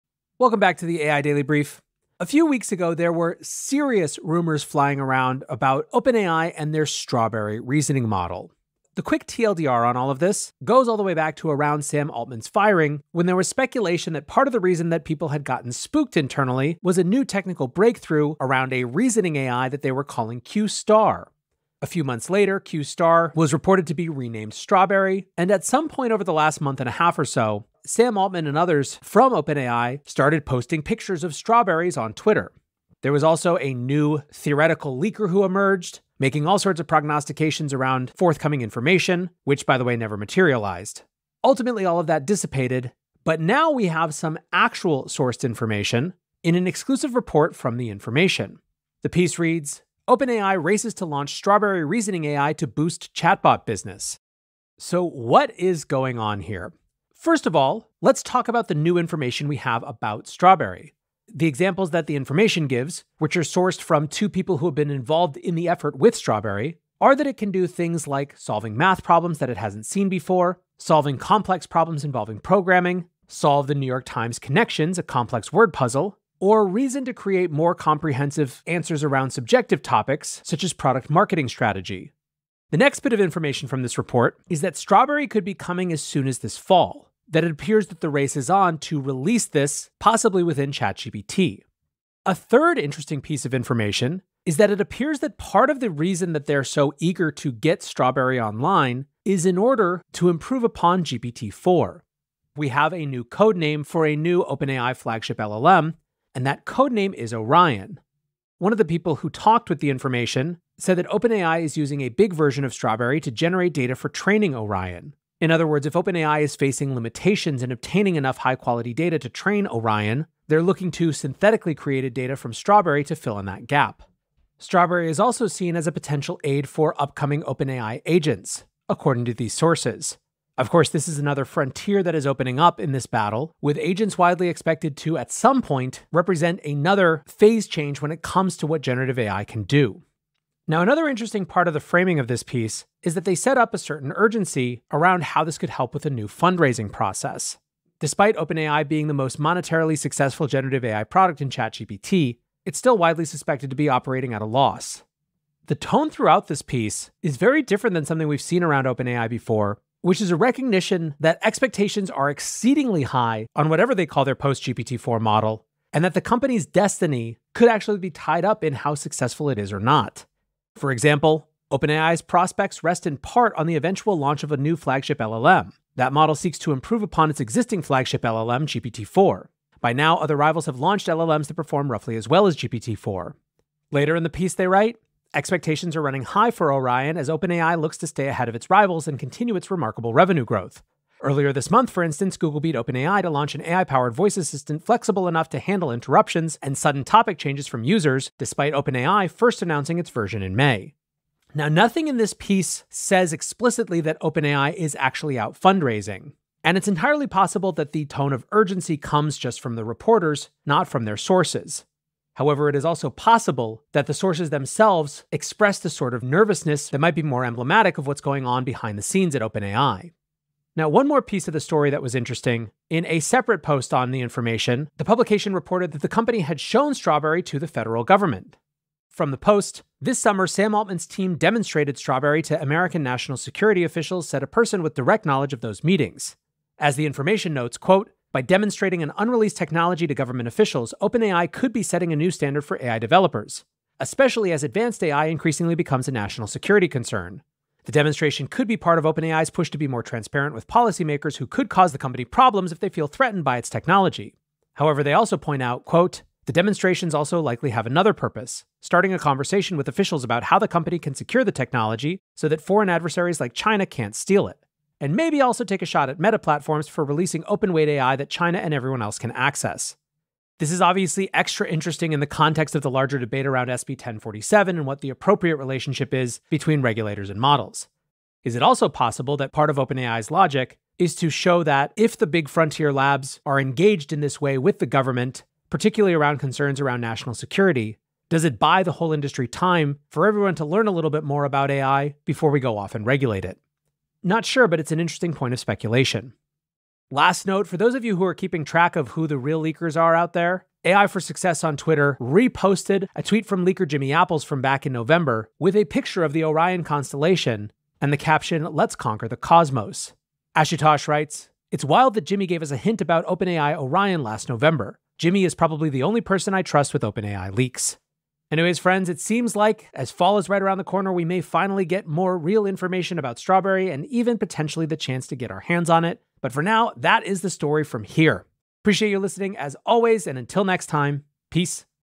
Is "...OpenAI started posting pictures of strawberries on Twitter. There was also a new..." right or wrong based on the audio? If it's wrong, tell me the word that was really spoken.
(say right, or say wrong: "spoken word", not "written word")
right.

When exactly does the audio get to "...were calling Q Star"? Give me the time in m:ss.
0:19.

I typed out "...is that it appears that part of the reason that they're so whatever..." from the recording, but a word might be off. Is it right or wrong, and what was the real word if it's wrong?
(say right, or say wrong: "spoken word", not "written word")
wrong: "eager", not "whatever".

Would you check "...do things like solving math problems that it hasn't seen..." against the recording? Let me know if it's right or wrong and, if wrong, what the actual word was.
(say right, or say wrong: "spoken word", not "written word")
right.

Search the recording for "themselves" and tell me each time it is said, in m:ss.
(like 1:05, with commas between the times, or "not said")
3:34.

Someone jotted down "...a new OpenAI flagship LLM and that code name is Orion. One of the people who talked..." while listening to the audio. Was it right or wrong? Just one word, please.
right.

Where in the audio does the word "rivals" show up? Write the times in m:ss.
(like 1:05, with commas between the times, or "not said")
3:00, 3:08.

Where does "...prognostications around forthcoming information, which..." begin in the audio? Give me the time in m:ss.
0:36.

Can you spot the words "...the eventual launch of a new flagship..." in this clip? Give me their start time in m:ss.
2:53.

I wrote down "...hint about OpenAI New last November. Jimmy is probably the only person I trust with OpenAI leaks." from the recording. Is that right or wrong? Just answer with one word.
wrong.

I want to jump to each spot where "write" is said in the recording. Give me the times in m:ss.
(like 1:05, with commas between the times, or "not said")
3:04, 5:11.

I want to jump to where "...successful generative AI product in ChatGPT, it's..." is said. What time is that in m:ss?
2:29.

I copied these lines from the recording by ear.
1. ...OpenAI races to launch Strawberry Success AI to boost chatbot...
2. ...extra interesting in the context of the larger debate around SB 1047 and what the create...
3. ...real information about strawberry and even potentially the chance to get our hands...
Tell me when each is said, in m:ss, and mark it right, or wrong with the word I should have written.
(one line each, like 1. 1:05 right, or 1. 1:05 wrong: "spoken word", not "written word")
1. 0:50 wrong: "Reasoning", not "Success"
2. 4:31 wrong: "appropriate", not "create"
3. 5:22 right.